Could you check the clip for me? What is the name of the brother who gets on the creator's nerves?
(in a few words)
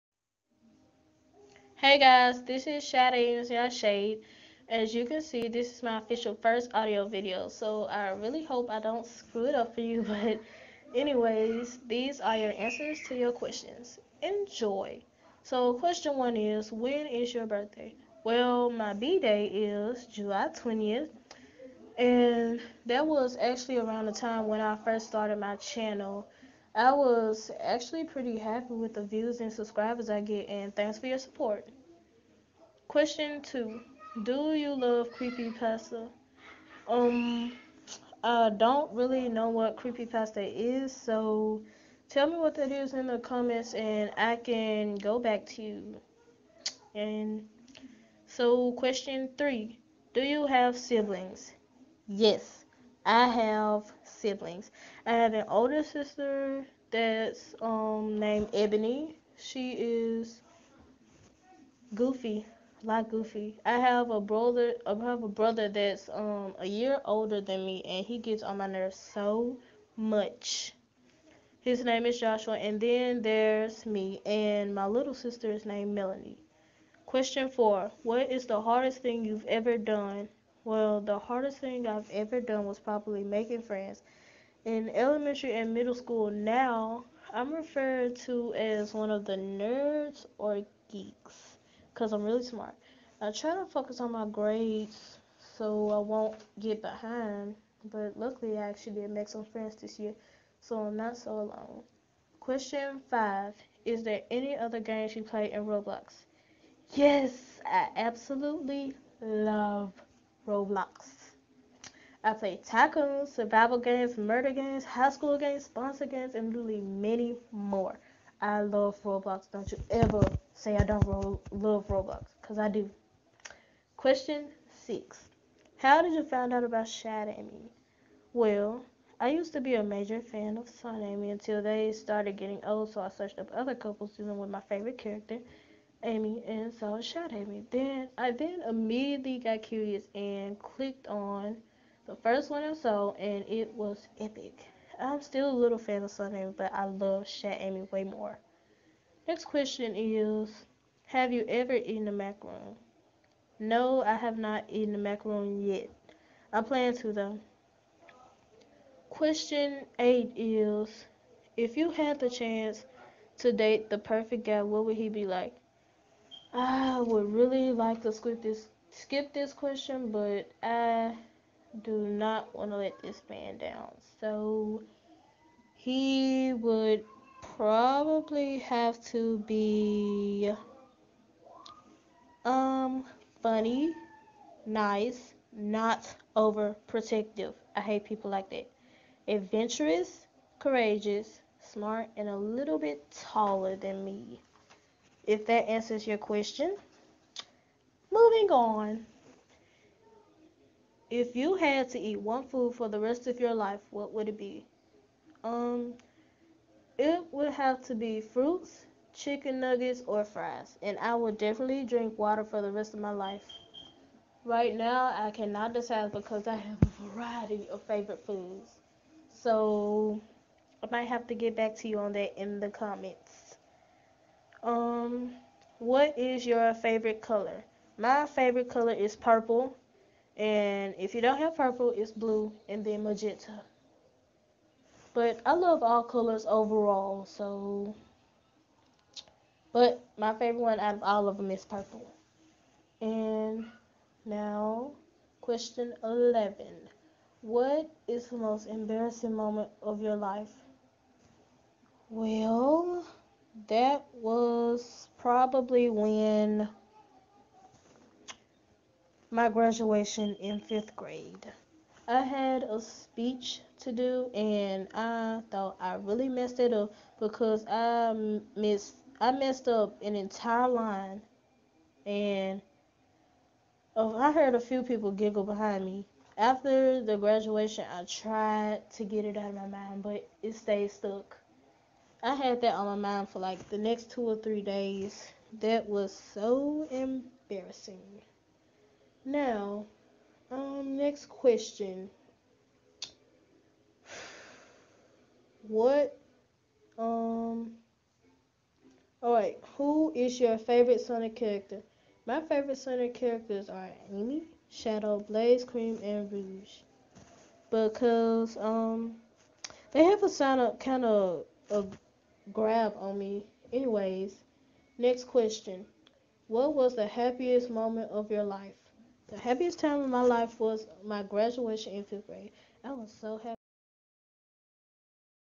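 Joshua.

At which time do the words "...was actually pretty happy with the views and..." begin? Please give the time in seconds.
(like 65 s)
26 s.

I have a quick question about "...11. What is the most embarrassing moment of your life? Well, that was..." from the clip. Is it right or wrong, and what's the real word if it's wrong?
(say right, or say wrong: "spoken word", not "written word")
right.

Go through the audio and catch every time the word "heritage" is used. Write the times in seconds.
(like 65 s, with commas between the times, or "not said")
not said.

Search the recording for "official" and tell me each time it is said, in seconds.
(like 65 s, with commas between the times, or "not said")
5 s.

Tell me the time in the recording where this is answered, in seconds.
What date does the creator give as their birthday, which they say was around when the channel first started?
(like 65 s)
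20 s.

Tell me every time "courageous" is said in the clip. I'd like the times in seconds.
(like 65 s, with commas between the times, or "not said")
190 s.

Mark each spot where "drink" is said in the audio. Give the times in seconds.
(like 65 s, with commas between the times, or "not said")
211 s.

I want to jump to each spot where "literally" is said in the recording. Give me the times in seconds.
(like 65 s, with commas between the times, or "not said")
116 s.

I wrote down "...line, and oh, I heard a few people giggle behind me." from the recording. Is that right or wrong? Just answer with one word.
right.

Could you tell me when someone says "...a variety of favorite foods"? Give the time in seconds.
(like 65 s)
216 s.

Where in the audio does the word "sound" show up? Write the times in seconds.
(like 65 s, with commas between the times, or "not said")
310 s.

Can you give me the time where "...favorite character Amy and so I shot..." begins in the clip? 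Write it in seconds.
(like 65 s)
134 s.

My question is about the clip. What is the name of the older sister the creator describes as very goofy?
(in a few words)
Ebony.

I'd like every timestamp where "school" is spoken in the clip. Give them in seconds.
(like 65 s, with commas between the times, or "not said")
85 s, 115 s.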